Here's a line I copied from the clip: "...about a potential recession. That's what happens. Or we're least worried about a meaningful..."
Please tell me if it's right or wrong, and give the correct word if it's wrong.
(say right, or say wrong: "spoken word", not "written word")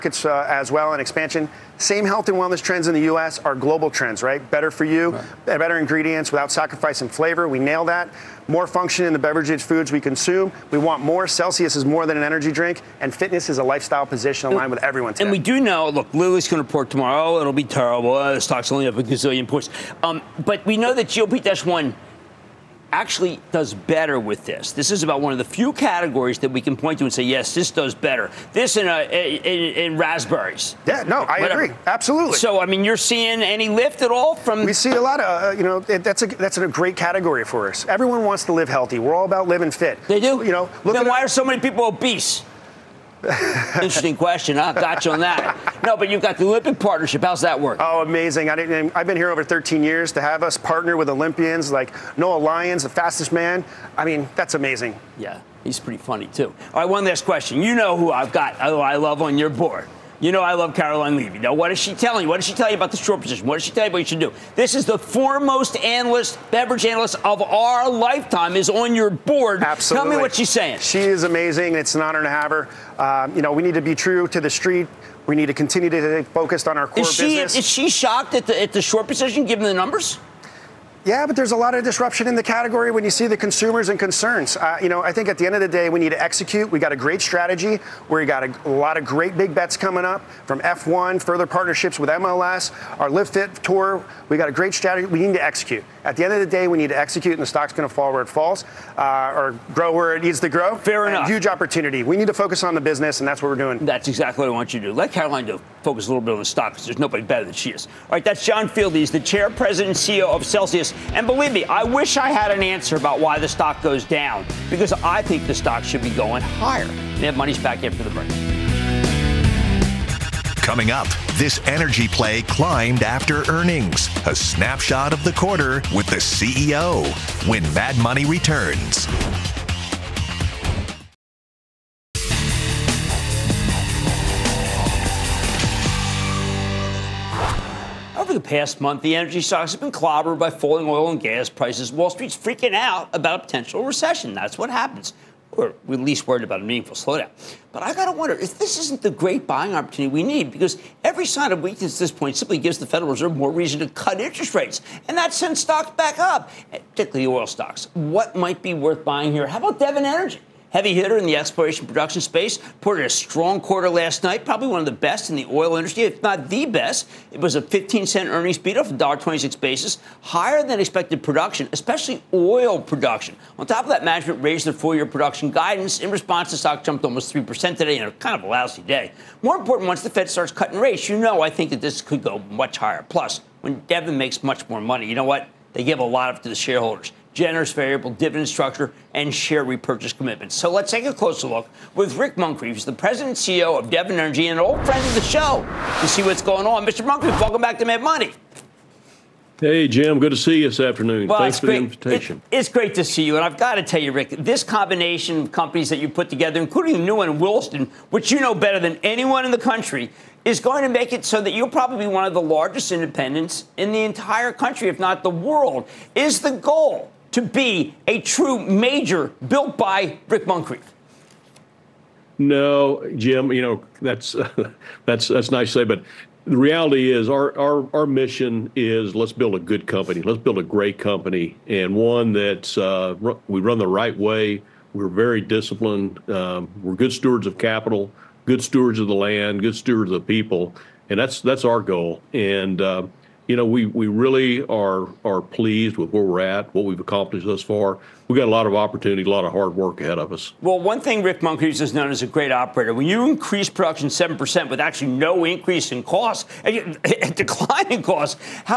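right.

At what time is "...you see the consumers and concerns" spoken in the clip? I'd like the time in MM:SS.
01:23.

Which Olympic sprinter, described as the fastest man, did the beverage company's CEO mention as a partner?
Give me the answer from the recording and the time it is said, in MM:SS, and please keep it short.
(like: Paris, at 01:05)
Noah Lyles, at 00:52.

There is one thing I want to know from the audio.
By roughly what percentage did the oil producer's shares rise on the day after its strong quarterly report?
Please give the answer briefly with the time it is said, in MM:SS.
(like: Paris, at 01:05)
3%, at 02:57.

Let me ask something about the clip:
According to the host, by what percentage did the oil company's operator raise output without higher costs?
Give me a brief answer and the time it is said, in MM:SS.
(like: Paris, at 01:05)
7%, at 04:14.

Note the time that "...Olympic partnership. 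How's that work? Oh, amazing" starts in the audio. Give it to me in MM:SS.
00:46.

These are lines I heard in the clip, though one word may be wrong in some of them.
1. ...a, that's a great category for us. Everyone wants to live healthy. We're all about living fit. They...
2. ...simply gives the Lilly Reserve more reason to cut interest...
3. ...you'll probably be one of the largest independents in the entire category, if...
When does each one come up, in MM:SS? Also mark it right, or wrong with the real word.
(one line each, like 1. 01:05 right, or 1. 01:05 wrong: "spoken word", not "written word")
1. 00:36 right
2. 02:32 wrong: "Federal", not "Lilly"
3. 03:31 wrong: "country", not "category".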